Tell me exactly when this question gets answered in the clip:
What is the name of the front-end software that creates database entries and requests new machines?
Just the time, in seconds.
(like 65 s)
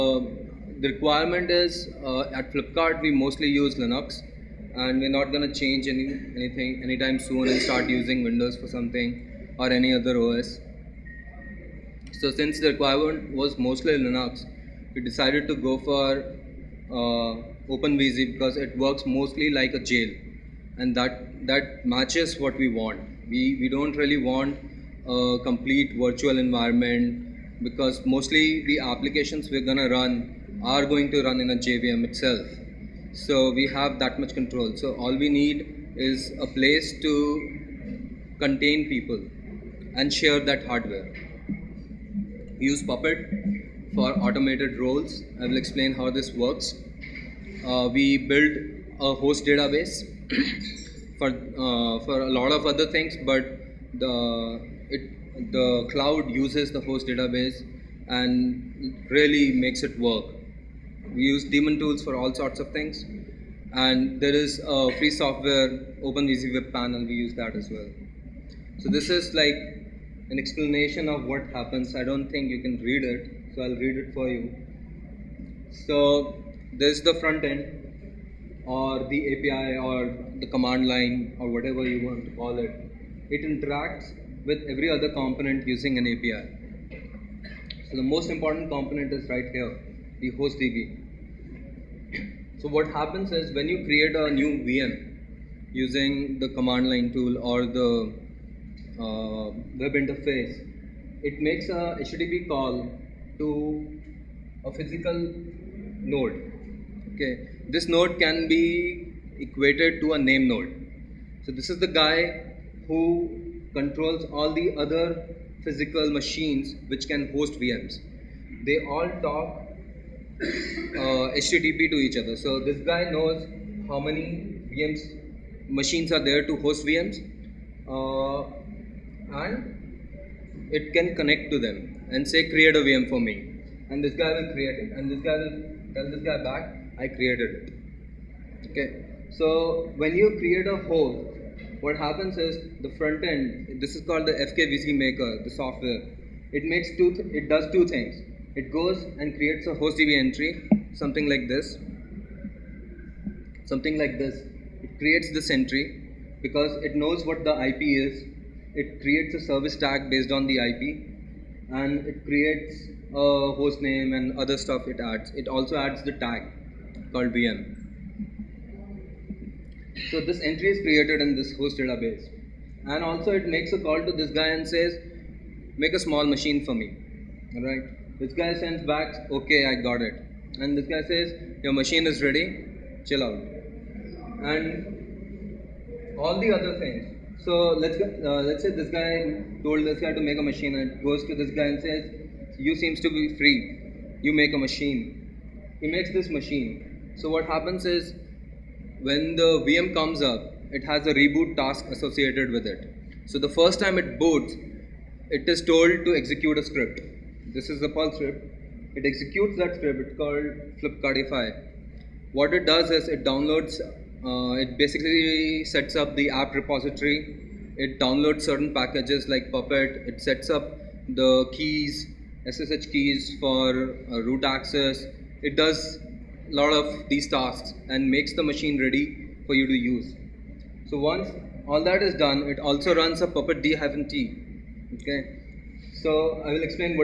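144 s.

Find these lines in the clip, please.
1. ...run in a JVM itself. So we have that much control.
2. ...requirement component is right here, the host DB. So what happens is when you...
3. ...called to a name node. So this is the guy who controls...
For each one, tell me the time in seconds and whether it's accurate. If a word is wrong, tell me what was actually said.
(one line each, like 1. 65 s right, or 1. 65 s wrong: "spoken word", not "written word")
1. 31 s right
2. 88 s wrong: "important", not "requirement"
3. 109 s wrong: "equated", not "called".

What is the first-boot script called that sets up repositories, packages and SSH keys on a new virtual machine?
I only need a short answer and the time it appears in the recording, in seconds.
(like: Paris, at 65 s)
Flipkartify, at 210 s.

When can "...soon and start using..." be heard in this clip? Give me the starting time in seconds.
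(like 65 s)
7 s.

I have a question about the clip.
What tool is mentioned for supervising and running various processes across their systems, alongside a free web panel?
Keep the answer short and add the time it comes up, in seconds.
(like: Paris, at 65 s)
daemon tools, at 61 s.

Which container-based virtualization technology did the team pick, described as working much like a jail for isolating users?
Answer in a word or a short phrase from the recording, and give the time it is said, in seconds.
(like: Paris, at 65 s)
OpenVZ, at 17 s.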